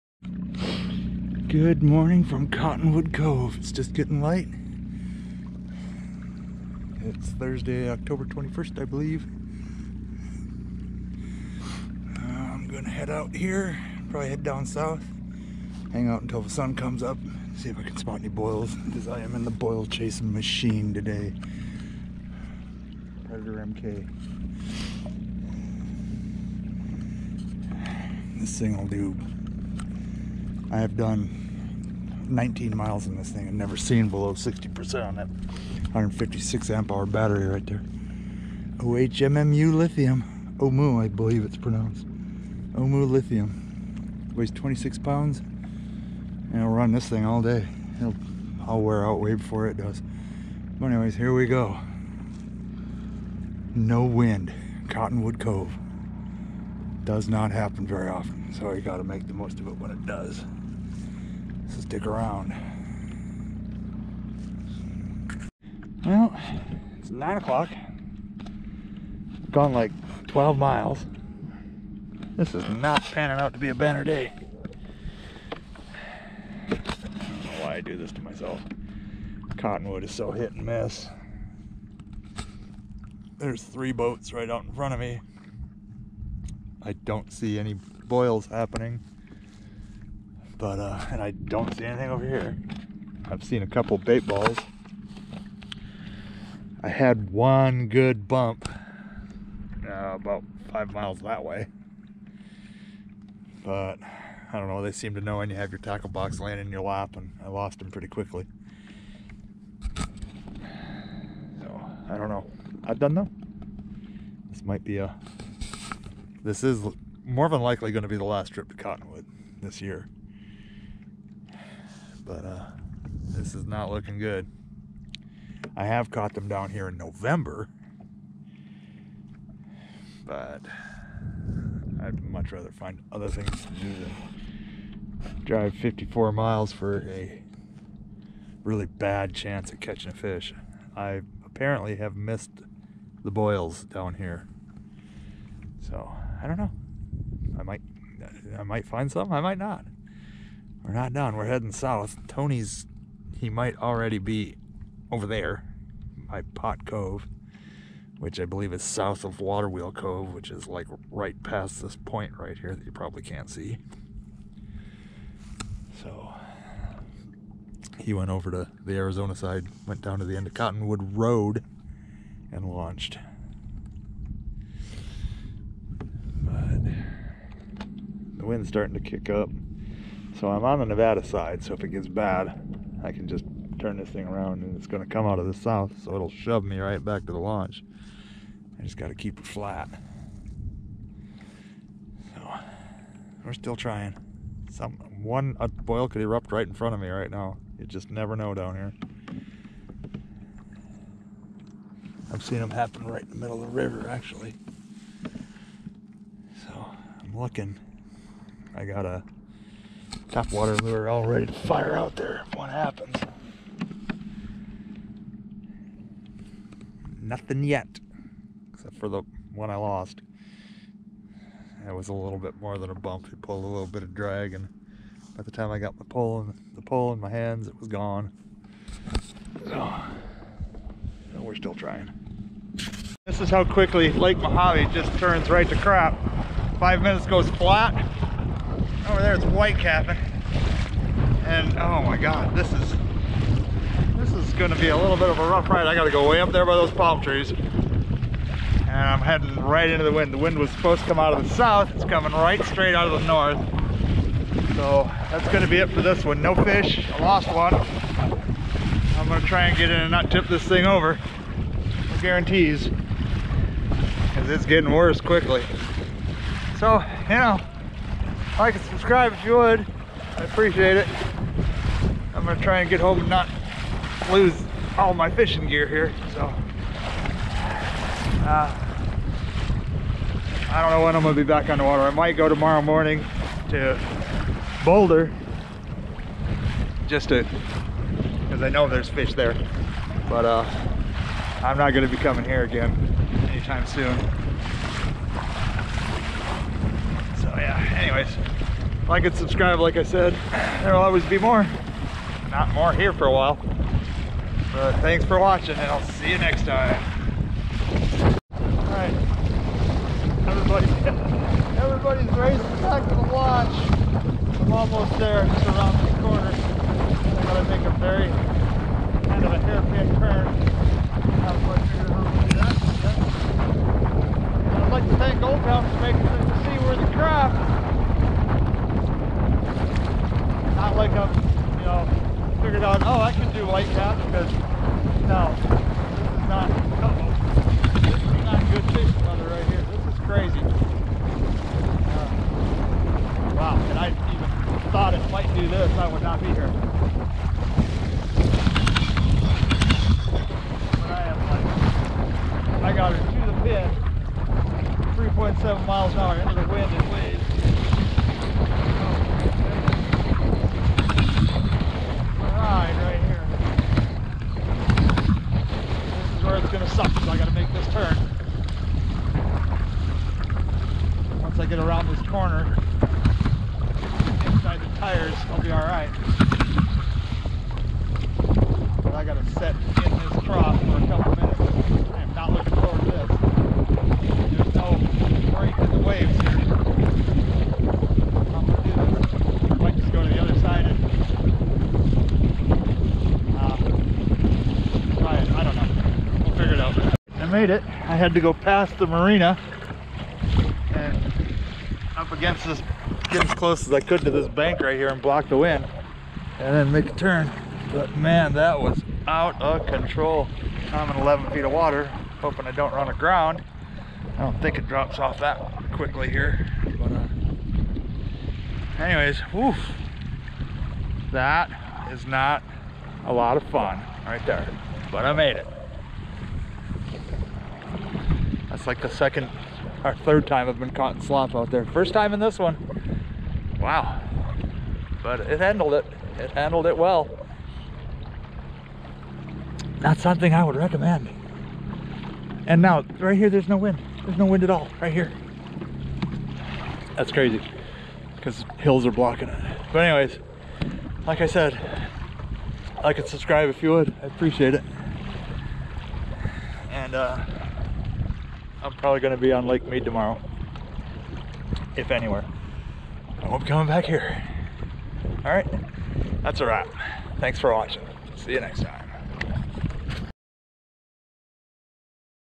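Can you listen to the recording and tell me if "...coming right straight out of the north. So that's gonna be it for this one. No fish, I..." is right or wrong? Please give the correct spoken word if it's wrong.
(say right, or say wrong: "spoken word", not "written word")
right.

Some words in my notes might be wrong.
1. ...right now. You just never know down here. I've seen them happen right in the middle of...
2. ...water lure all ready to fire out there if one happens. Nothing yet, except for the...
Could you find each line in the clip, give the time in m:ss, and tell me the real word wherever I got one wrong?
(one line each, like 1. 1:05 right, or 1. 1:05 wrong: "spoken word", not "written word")
1. 3:17 right
2. 3:30 right.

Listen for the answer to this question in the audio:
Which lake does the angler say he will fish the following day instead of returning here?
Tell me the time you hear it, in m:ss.
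7:39.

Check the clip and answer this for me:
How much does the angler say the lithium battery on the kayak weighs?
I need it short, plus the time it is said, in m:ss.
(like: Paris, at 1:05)
26 pounds, at 0:44.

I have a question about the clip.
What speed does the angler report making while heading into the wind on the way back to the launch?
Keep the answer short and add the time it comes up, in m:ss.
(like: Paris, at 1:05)
3.7 miles an hour, at 5:55.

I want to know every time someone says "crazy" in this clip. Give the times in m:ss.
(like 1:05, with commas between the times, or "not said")
5:40, 7:27.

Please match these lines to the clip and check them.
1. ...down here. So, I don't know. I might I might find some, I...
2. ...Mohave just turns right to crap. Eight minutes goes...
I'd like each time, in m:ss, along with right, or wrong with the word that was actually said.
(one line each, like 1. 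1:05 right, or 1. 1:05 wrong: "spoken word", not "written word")
1. 2:23 right
2. 3:54 wrong: "Five", not "Eight".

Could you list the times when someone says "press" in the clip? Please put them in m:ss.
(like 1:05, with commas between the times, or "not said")
not said.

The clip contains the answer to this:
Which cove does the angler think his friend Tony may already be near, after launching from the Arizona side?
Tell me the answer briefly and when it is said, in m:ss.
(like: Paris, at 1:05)
Pot Cove, at 2:36.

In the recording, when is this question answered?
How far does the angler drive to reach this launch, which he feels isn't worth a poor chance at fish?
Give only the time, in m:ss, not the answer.
2:15.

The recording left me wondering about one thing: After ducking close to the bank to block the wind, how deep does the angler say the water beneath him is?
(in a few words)
11 feet.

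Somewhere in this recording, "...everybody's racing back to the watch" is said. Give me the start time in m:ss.
5:11.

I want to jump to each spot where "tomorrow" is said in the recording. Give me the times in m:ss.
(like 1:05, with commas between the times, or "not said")
4:42, 7:40.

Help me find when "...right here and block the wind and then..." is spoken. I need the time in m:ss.
6:44.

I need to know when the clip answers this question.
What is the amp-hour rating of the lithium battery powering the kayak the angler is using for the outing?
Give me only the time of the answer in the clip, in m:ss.
0:35.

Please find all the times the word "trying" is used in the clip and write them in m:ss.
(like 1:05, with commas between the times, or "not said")
3:13, 3:51.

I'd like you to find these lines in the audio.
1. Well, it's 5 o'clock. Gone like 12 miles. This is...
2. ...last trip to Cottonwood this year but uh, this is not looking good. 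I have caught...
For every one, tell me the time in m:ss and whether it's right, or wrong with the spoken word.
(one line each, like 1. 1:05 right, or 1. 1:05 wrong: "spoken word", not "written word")
1. 1:06 wrong: "9", not "5"
2. 1:58 right.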